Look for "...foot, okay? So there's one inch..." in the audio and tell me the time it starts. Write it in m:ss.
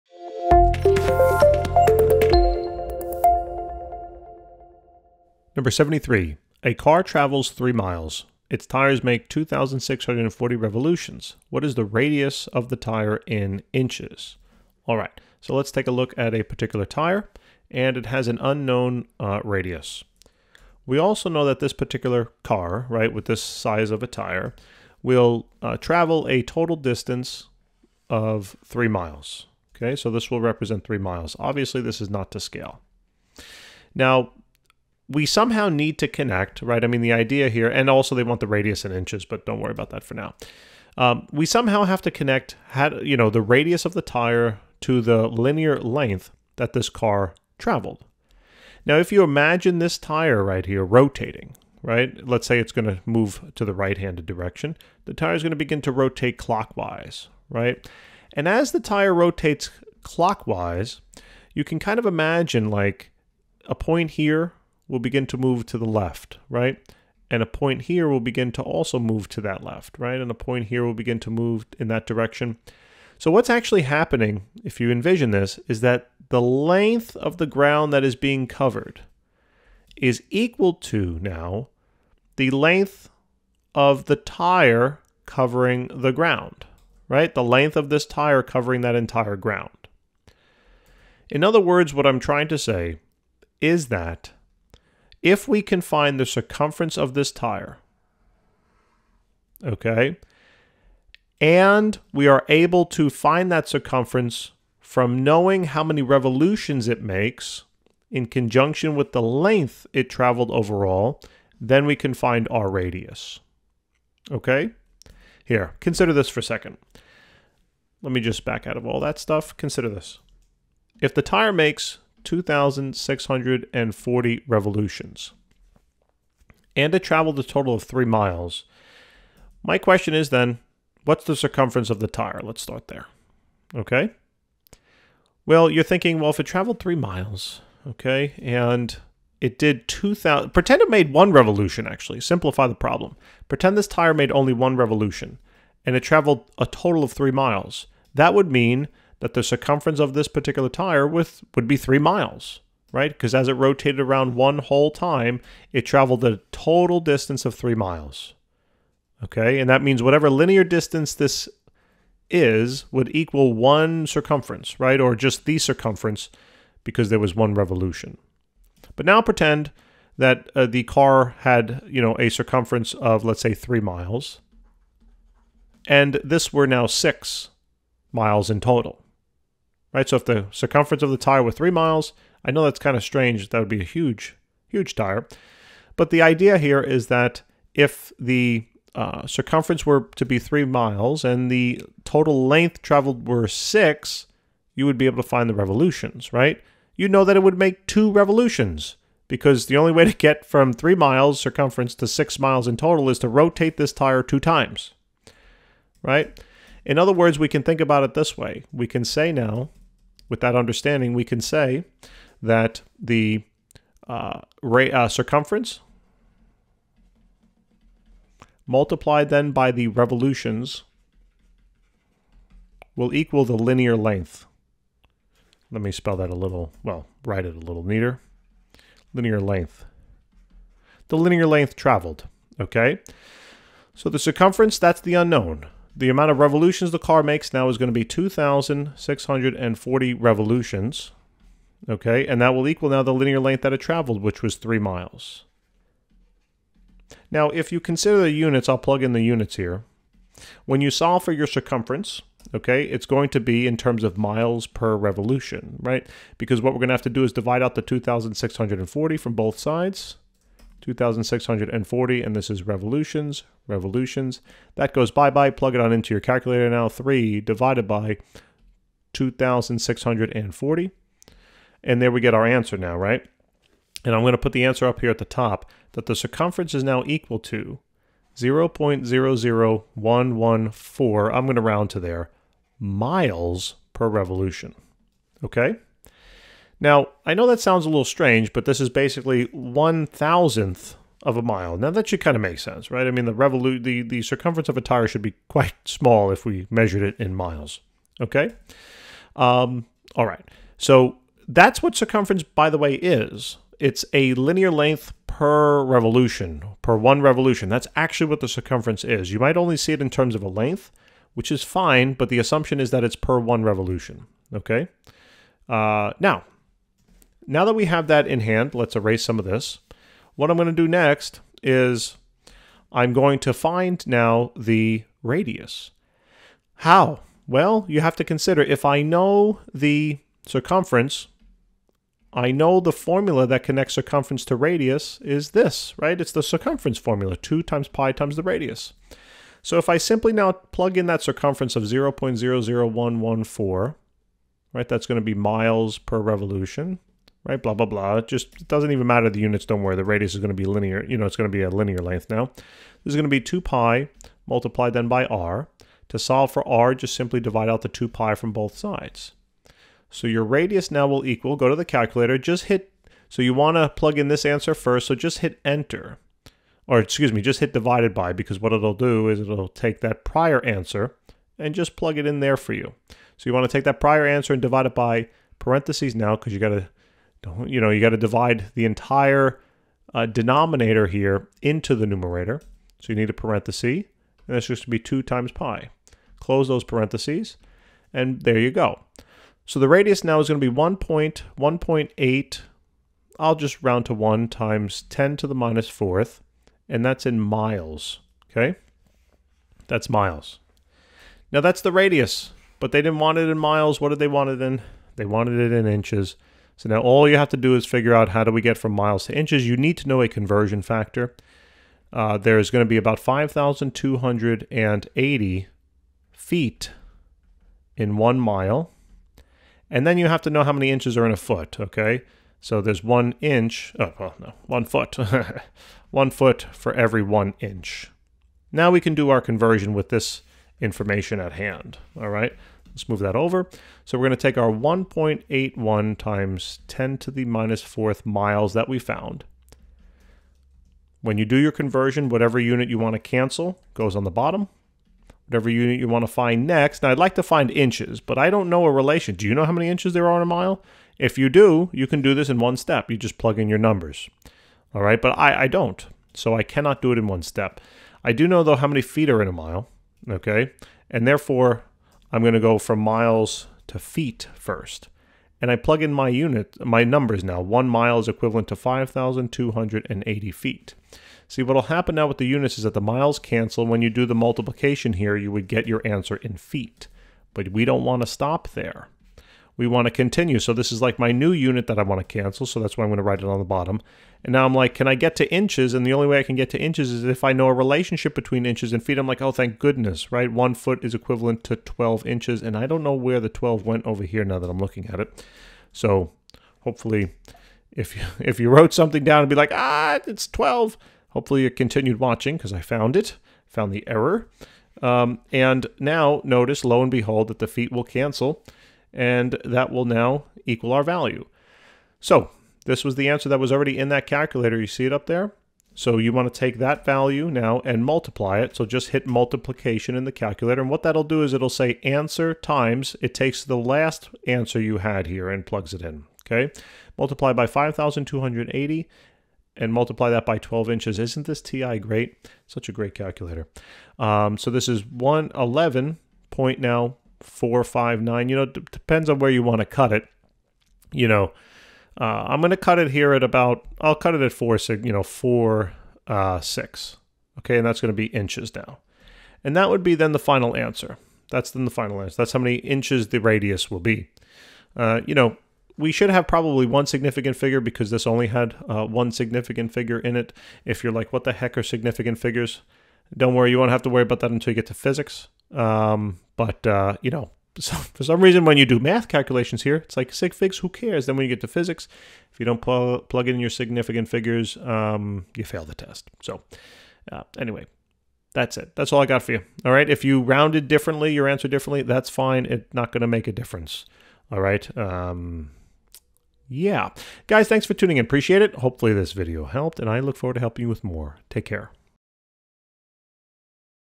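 7:01.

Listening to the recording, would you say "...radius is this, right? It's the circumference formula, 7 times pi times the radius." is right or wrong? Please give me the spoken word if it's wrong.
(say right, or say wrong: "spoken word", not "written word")
wrong: "2", not "7".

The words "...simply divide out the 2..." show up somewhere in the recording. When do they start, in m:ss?
5:57.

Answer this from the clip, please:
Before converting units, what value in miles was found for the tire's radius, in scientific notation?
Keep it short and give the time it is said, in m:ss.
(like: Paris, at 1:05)
1.81 x 10^-4, at 7:14.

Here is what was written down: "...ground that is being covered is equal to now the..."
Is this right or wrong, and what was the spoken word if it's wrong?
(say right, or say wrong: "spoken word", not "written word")
right.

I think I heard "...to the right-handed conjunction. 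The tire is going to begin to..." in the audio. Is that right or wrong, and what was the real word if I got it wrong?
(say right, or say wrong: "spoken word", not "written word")
wrong: "direction", not "conjunction".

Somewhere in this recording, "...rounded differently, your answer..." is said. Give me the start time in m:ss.
9:40.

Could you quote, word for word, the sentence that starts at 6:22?
So you need a parenthesis, and that's just to be 2 times pi.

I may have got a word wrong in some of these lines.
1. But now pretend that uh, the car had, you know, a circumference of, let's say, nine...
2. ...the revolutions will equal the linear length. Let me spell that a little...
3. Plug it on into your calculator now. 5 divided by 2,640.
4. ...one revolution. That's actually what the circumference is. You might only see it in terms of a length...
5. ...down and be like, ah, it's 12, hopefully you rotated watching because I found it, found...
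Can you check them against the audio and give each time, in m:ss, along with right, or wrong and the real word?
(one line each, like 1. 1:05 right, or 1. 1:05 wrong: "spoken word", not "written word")
1. 2:48 wrong: "three", not "nine"
2. 3:39 right
3. 4:25 wrong: "3", not "5"
4. 5:06 right
5. 8:19 wrong: "continued", not "rotated".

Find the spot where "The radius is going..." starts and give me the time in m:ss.
5:49.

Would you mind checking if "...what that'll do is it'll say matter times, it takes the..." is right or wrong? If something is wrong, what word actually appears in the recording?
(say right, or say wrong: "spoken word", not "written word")
wrong: "answer", not "matter".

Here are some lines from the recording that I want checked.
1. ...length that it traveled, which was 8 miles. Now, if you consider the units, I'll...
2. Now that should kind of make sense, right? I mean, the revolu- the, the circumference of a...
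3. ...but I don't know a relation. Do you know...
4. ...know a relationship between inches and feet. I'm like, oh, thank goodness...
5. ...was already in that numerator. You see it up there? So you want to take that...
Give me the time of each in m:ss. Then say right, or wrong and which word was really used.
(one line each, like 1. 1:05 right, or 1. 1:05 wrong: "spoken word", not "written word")
1. 4:03 wrong: "3", not "8"
2. 4:51 right
3. 7:28 right
4. 8:07 right
5. 8:33 wrong: "calculator", not "numerator".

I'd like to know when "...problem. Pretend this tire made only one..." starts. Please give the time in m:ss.
2:22.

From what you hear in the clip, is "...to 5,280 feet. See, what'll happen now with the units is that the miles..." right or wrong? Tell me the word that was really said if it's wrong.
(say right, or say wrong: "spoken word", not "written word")
right.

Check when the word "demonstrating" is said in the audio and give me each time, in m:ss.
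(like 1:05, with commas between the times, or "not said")
not said.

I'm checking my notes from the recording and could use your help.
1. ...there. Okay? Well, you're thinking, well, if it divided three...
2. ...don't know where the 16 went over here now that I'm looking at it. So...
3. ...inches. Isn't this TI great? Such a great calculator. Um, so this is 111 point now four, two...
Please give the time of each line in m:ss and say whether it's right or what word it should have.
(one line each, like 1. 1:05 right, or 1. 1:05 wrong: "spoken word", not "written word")
1. 2:12 wrong: "traveled", not "divided"
2. 8:12 wrong: "12", not "16"
3. 8:50 wrong: "five", not "two".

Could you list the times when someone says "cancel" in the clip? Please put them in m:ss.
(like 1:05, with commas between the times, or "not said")
7:23, 7:53, 8:02, 8:28.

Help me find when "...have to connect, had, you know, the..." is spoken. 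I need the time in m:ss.
0:41.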